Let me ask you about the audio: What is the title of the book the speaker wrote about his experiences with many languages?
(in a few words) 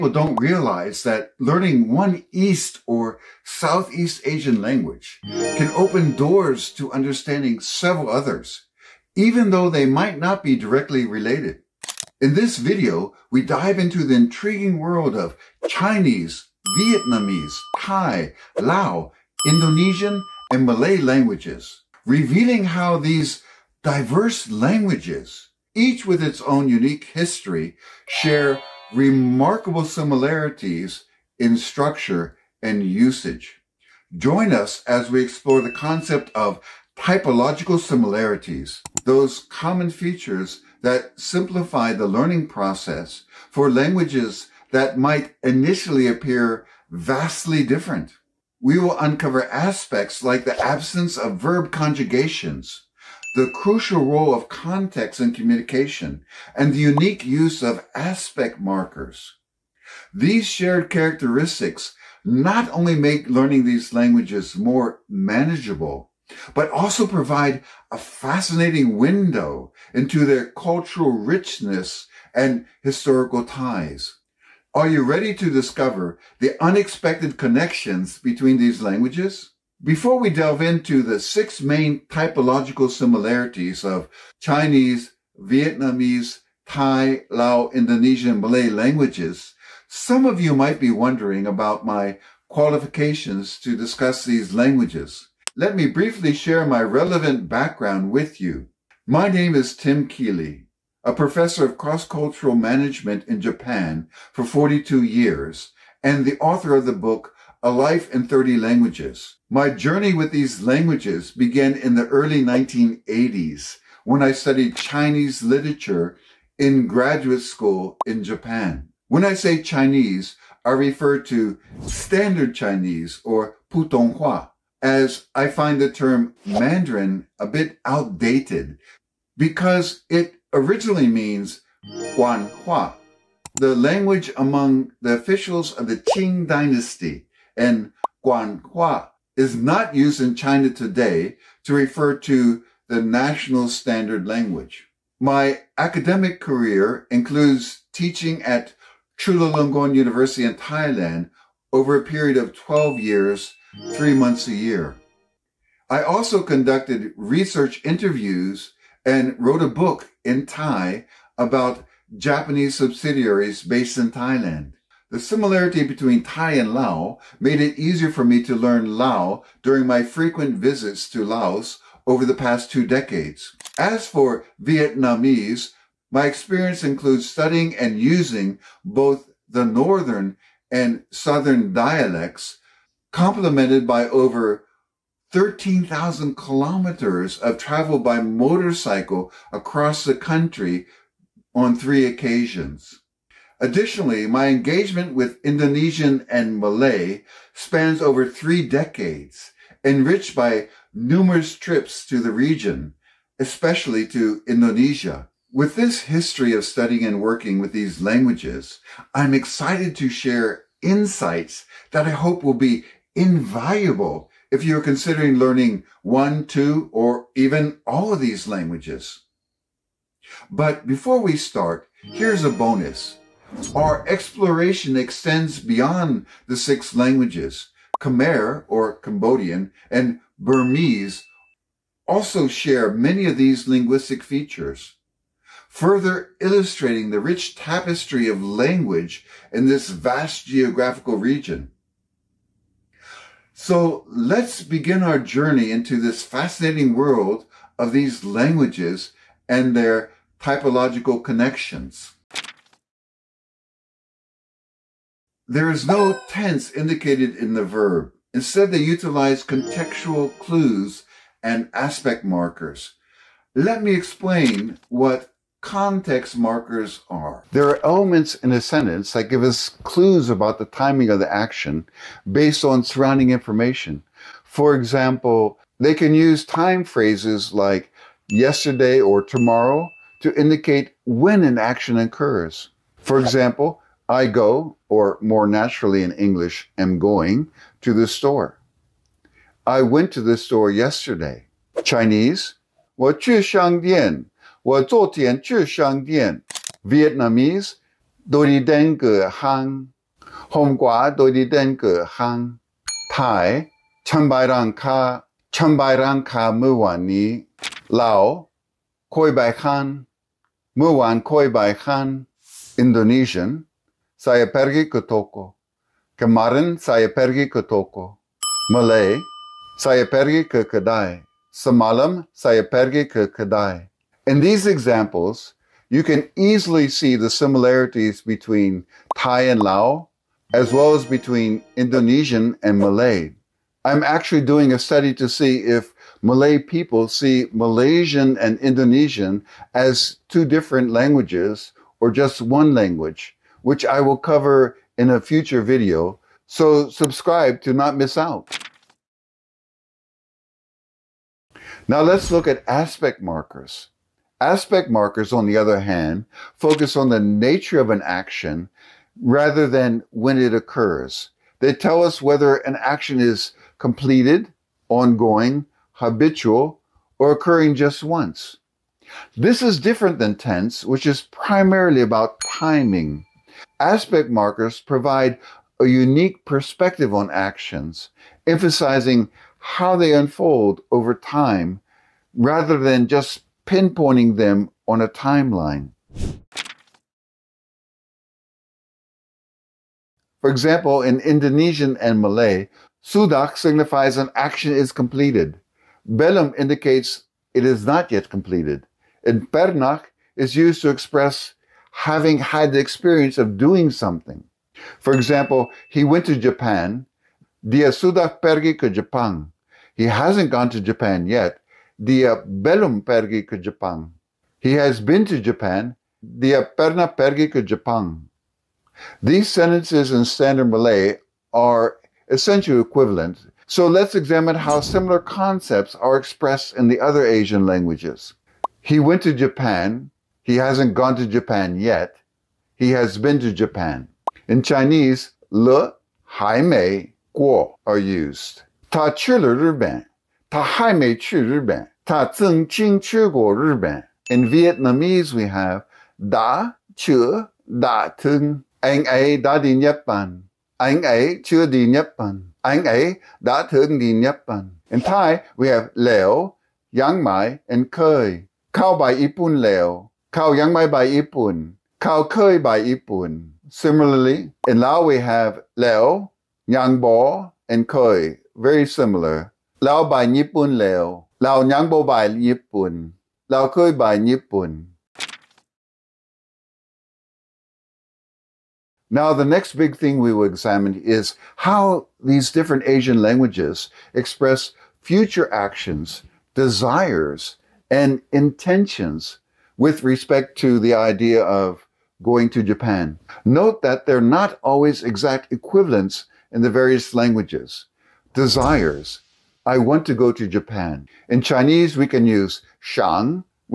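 A Life in 30 Languages.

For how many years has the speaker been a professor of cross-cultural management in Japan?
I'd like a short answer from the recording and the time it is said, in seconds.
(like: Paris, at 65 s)
42, at 104 s.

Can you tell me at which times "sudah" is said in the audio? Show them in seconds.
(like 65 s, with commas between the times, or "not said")
393 s, 407 s.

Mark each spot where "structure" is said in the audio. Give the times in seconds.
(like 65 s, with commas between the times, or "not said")
31 s.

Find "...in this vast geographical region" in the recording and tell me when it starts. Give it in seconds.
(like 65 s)
239 s.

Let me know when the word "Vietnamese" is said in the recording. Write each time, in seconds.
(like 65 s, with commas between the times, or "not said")
16 s, 85 s, 174 s, 296 s, 444 s.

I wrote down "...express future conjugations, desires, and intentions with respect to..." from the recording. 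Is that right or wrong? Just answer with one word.
wrong.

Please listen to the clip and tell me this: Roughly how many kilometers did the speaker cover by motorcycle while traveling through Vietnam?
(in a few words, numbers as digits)
13,000.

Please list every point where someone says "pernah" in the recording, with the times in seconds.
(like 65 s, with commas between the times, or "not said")
399 s, 416 s.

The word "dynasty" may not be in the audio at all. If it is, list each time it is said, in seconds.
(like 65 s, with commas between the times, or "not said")
136 s.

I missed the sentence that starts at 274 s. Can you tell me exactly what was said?
For example, they can use time phrases like yesterday or tomorrow to indicate when an action occurs.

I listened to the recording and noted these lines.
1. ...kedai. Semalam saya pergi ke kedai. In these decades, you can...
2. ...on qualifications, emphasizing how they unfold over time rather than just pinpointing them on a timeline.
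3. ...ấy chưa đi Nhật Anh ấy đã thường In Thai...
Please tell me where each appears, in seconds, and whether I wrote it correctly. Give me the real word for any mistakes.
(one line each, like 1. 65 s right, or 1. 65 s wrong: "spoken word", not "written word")
1. 320 s wrong: "examples", not "decades"
2. 377 s wrong: "actions", not "qualifications"
3. 451 s right.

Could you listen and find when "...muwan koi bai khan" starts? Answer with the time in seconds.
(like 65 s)
310 s.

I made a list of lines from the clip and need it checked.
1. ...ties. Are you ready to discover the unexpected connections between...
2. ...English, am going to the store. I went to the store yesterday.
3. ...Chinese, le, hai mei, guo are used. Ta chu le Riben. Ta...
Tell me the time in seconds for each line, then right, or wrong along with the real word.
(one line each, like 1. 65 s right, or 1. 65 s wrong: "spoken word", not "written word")
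1. 73 s right
2. 286 s right
3. 434 s right.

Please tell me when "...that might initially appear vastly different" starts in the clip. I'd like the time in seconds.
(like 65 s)
44 s.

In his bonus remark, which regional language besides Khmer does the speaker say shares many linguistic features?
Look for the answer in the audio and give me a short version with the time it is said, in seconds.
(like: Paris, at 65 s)
Burmese, at 230 s.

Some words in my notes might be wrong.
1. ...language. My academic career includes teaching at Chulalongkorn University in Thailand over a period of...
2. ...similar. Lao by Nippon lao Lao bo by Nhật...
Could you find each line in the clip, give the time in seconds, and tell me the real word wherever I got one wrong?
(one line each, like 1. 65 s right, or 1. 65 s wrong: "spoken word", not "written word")
1. 144 s right
2. 468 s wrong: "Nippon", not "Nhật".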